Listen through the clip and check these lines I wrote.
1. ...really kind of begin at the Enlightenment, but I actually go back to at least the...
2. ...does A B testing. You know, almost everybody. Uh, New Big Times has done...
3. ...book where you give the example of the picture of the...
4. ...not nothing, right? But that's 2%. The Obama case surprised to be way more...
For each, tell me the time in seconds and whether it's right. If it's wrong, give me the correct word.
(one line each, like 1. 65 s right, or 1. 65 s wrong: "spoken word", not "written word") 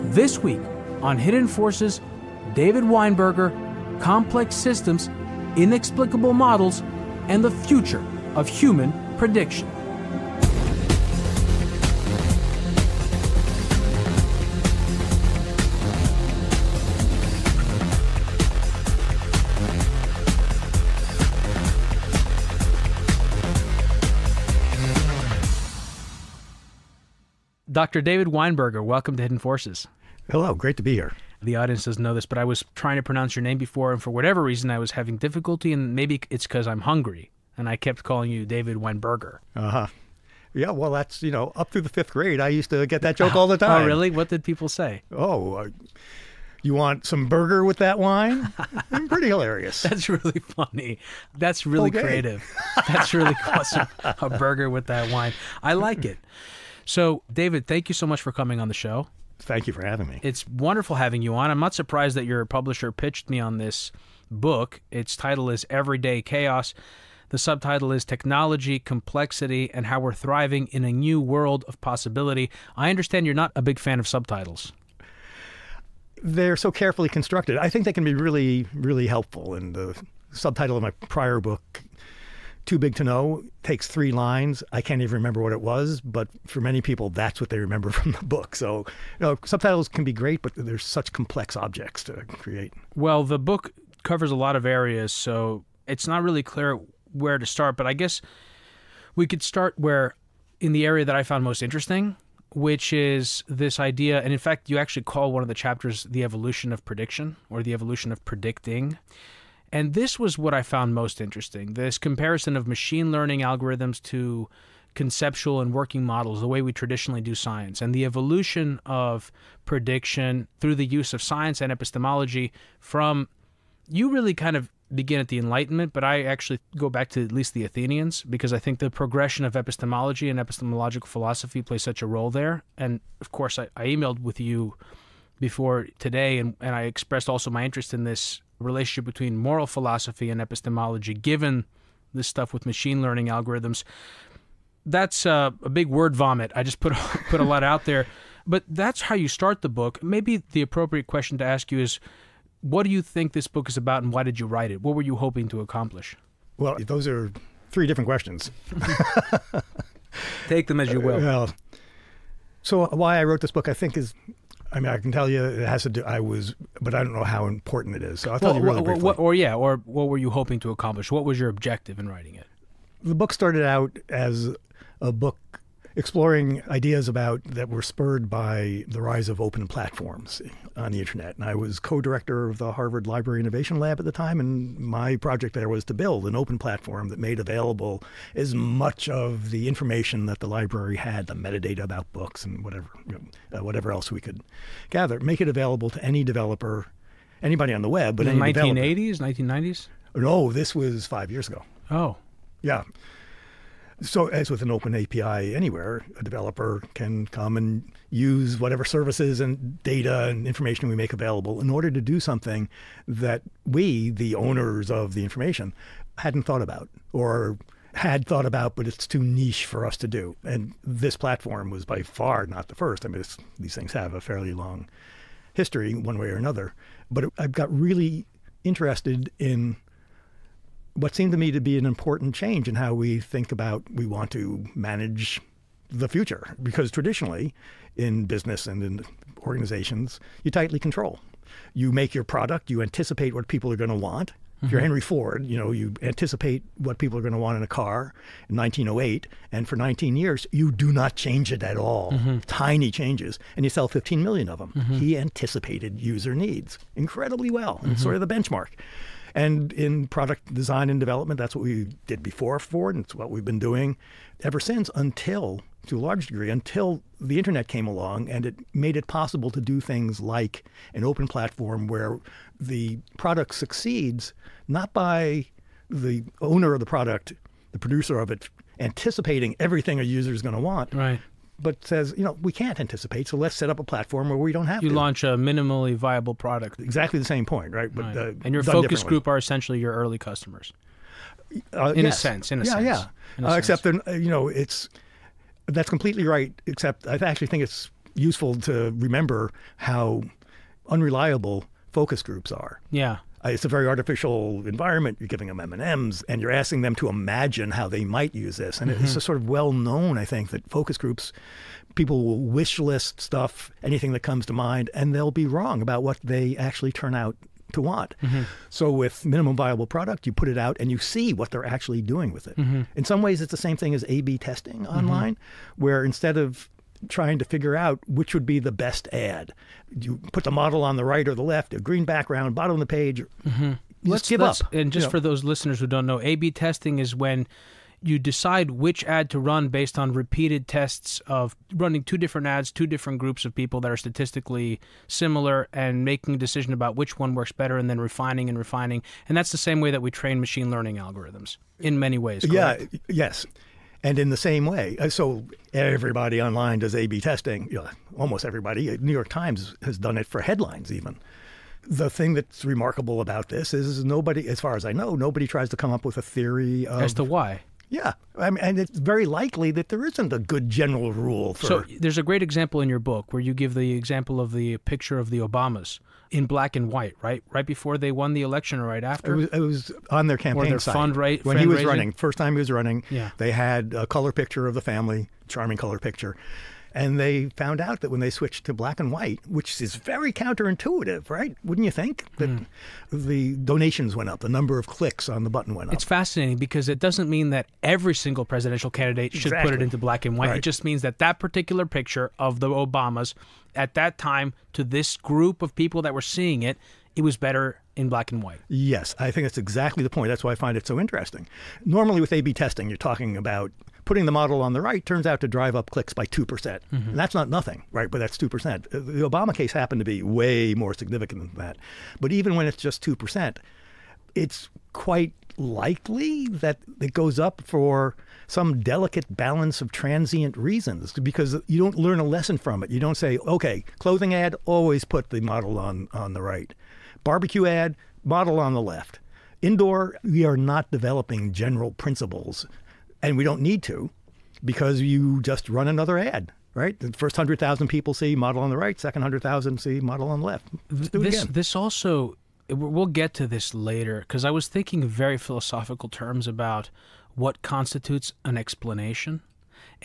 1. 124 s right
2. 356 s wrong: "York", not "Big"
3. 372 s right
4. 417 s wrong: "happened", not "surprised".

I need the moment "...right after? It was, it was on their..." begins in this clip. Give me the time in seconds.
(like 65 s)
378 s.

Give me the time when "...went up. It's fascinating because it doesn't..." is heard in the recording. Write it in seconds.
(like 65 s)
395 s.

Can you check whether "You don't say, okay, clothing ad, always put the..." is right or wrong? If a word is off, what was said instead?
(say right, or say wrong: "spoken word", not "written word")
right.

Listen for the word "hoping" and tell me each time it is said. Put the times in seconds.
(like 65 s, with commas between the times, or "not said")
155 s, 170 s.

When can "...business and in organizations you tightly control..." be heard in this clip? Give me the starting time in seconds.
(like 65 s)
238 s.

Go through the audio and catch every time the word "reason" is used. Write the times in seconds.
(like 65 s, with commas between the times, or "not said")
34 s, 430 s.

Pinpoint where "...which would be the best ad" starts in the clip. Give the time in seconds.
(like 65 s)
328 s.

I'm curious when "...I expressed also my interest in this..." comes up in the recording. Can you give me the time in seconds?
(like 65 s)
136 s.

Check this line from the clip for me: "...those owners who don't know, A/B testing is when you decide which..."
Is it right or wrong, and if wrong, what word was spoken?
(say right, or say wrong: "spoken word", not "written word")
wrong: "listeners", not "owners".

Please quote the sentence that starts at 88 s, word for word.
So, you know, subtitles can be great, but there's such complex objects to create.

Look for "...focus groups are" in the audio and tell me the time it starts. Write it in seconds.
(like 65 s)
301 s.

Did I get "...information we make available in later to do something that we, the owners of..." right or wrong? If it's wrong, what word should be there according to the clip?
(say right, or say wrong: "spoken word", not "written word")
wrong: "order", not "later".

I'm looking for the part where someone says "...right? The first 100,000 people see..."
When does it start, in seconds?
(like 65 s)
446 s.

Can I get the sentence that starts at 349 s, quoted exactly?
And that's the same way that we train machine learning algorithms in many ways.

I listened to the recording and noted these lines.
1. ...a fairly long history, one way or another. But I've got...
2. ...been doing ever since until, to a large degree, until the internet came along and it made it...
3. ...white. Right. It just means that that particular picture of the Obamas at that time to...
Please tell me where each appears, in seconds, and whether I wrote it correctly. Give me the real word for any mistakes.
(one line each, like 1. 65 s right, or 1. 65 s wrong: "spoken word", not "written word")
1. 224 s right
2. 263 s right
3. 400 s right.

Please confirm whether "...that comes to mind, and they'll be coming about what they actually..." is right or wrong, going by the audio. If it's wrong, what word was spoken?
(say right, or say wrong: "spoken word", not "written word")
wrong: "wrong", not "coming".